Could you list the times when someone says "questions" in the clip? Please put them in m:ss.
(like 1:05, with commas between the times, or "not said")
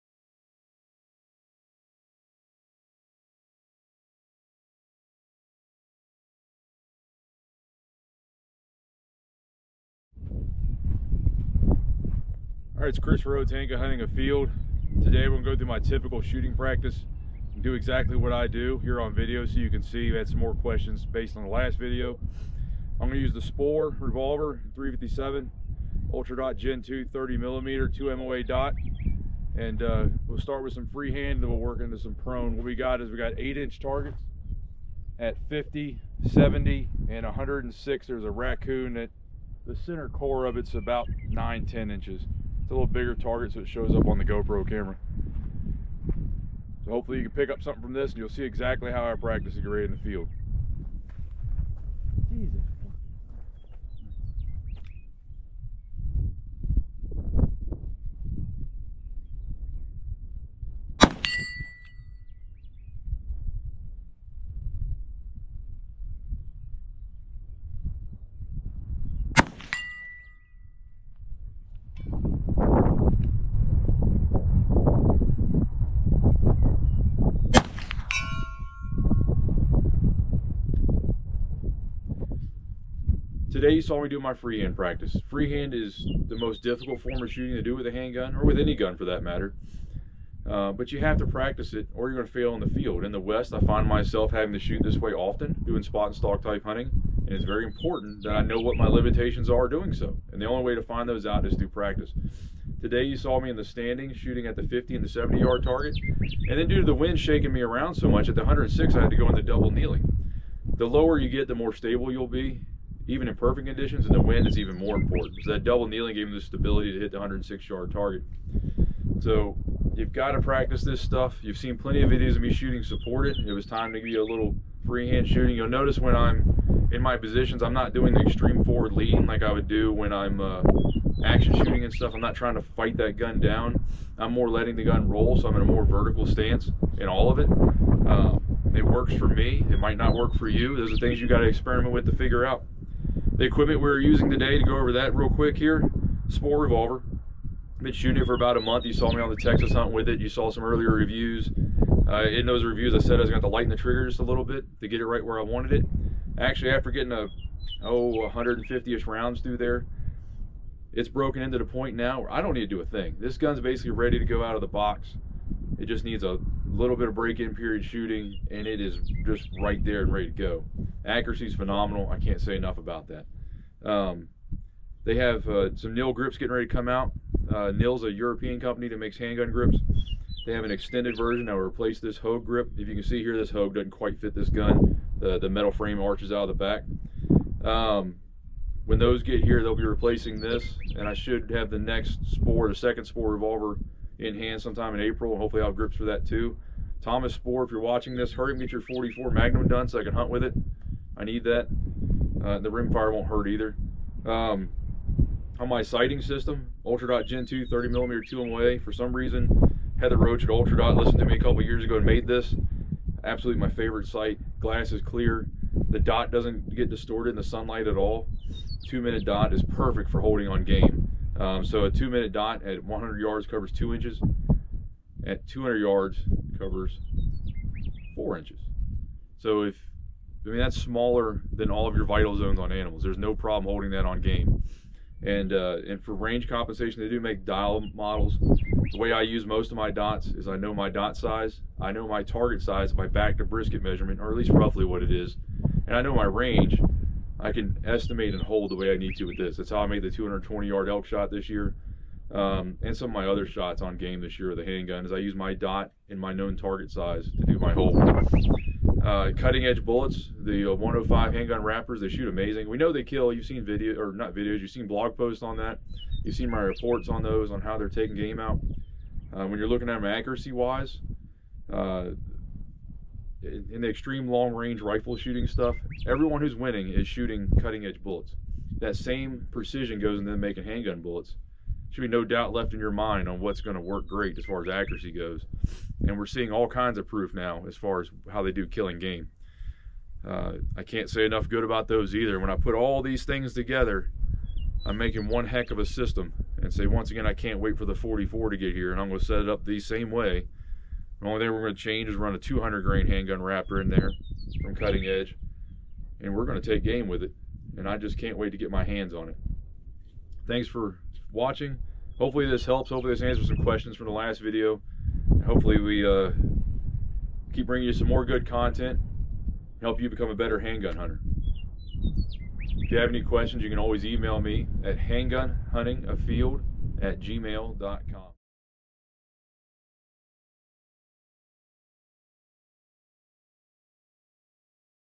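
0:20, 5:13, 5:23.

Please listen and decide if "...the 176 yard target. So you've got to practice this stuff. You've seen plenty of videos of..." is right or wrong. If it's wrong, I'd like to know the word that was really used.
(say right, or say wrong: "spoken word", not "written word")
wrong: "106", not "176".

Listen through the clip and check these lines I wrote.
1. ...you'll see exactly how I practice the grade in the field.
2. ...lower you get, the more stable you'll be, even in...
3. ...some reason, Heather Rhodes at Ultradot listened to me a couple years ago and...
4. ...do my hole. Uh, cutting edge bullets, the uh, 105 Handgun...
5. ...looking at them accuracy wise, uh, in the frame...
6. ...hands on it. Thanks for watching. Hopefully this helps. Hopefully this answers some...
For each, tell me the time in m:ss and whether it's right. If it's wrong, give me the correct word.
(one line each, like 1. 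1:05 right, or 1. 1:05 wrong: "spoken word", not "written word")
1. 0:48 right
2. 1:50 right
3. 3:28 wrong: "Roach", not "Rhodes"
4. 4:17 right
5. 4:29 wrong: "extreme", not "frame"
6. 5:08 right.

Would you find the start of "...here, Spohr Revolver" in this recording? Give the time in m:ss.
2:25.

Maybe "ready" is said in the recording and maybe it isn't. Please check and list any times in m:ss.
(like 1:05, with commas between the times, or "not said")
2:43, 2:50, 2:56.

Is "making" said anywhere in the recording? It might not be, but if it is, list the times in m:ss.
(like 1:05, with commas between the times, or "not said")
4:40, 4:54.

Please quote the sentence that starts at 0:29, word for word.
And uh, we'll start with some freehand, then we'll work into some prone.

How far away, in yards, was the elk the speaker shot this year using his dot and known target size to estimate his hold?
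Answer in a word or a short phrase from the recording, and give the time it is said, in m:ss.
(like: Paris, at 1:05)
220, at 4:10.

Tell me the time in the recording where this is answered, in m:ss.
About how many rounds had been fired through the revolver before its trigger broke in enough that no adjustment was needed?
2:38.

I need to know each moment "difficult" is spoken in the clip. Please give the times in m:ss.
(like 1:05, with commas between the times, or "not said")
1:26.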